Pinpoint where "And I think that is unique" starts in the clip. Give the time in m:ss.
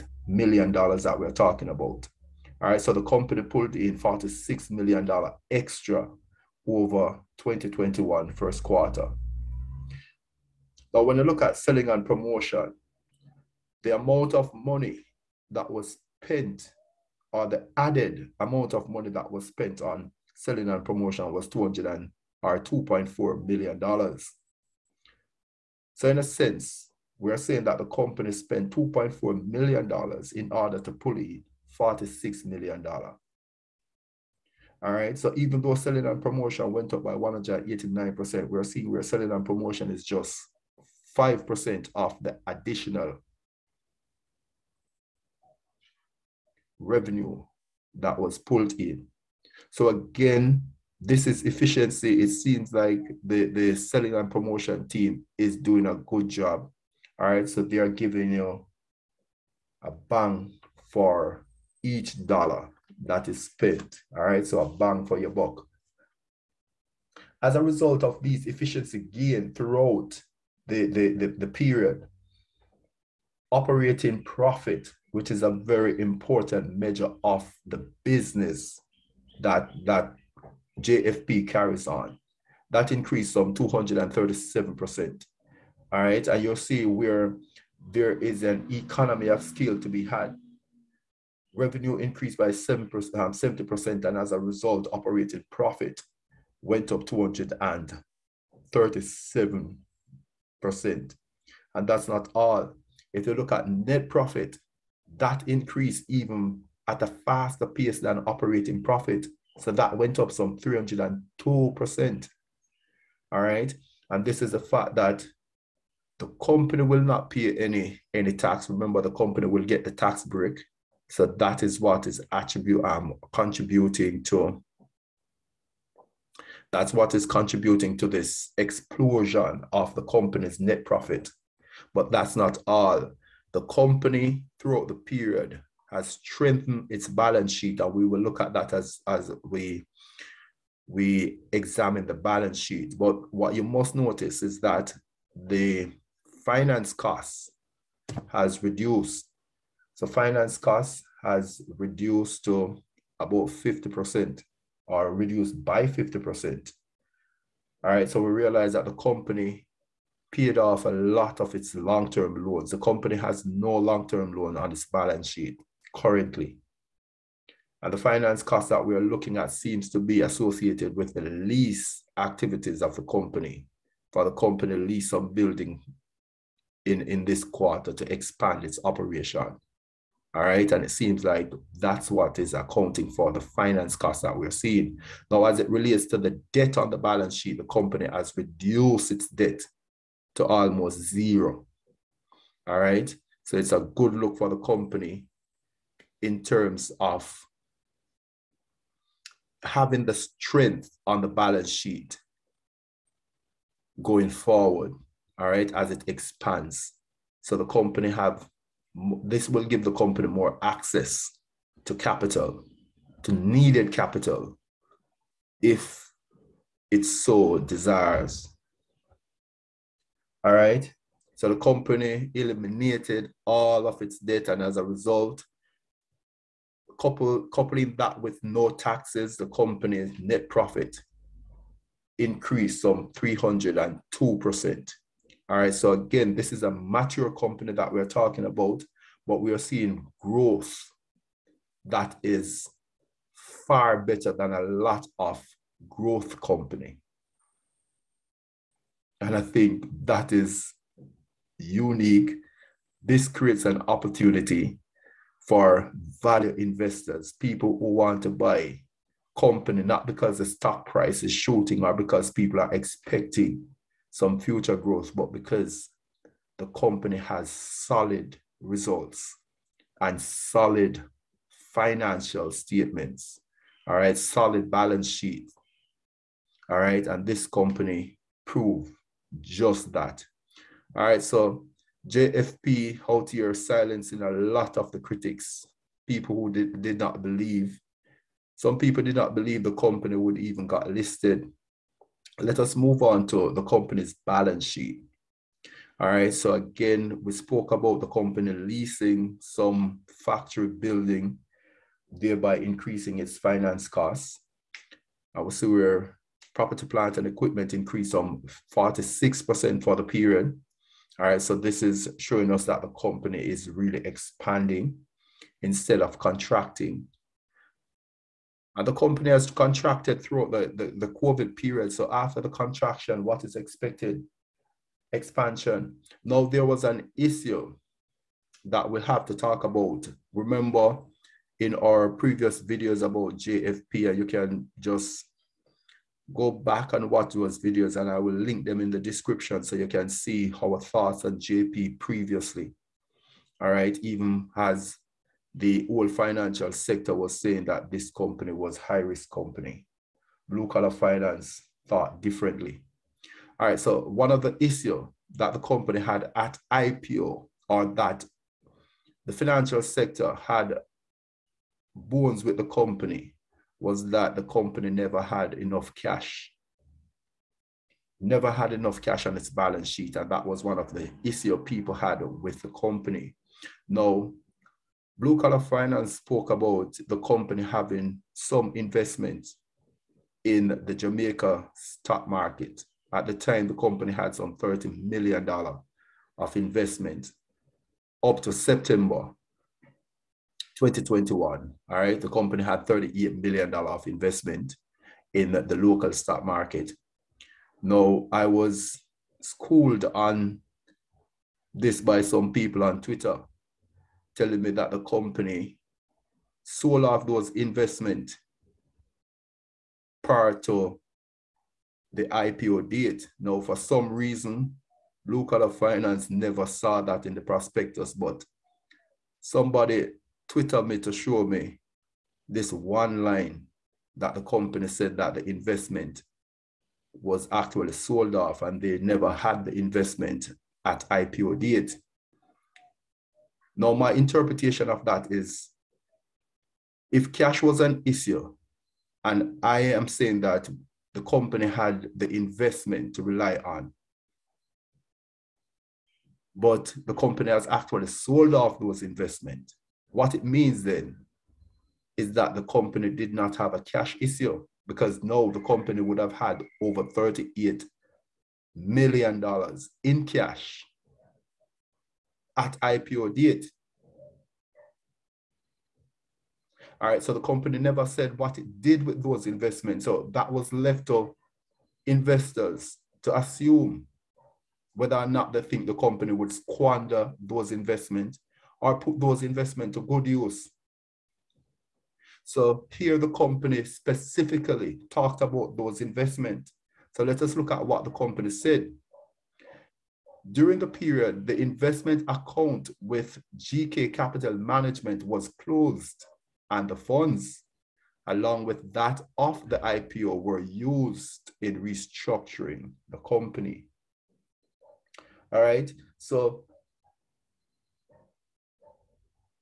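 4:09.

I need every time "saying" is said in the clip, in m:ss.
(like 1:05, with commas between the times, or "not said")
0:27, 5:47, 7:20.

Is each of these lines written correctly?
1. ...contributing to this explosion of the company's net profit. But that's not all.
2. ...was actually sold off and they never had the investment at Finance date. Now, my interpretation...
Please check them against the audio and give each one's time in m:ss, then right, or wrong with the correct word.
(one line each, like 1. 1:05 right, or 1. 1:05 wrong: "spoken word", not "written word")
1. 2:07 right
2. 7:07 wrong: "IPO", not "Finance".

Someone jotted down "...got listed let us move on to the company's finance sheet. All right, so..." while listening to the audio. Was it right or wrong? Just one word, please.
wrong.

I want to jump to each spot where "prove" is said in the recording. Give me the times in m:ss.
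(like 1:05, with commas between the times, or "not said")
4:38.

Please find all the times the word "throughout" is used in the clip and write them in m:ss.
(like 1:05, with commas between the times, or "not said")
1:09, 2:14, 5:20.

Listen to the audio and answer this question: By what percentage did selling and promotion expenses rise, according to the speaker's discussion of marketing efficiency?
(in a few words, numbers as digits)
189%.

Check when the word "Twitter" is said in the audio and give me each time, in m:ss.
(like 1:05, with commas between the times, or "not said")
6:43, 7:00.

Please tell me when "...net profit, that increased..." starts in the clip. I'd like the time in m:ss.
1:43.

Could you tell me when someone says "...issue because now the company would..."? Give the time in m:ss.
7:34.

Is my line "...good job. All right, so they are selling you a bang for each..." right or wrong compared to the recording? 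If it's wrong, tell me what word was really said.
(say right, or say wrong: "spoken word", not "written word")
wrong: "giving", not "selling".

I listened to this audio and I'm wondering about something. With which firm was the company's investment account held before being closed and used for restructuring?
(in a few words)
GK Capital Management.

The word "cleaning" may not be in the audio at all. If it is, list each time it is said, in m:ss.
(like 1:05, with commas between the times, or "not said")
not said.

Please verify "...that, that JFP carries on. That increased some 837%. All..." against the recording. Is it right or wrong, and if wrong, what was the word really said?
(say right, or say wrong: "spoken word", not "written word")
wrong: "237", not "837".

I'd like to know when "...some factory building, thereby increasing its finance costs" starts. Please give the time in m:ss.
4:59.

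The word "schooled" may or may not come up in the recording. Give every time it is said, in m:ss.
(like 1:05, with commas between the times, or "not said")
6:39.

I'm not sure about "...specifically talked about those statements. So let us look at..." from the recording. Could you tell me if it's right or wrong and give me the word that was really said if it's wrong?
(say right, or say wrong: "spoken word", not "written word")
wrong: "investments", not "statements".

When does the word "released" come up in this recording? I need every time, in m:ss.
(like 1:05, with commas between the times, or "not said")
not said.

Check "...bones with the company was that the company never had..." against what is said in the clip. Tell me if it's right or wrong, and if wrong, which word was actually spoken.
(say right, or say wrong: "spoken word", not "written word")
right.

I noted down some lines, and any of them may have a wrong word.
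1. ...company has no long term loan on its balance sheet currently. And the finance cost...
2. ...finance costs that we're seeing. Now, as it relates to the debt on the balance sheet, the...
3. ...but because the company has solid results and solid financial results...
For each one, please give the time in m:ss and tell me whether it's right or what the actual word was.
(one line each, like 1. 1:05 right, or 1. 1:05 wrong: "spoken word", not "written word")
1. 2:42 right
2. 3:03 right
3. 4:25 wrong: "statements", not "results".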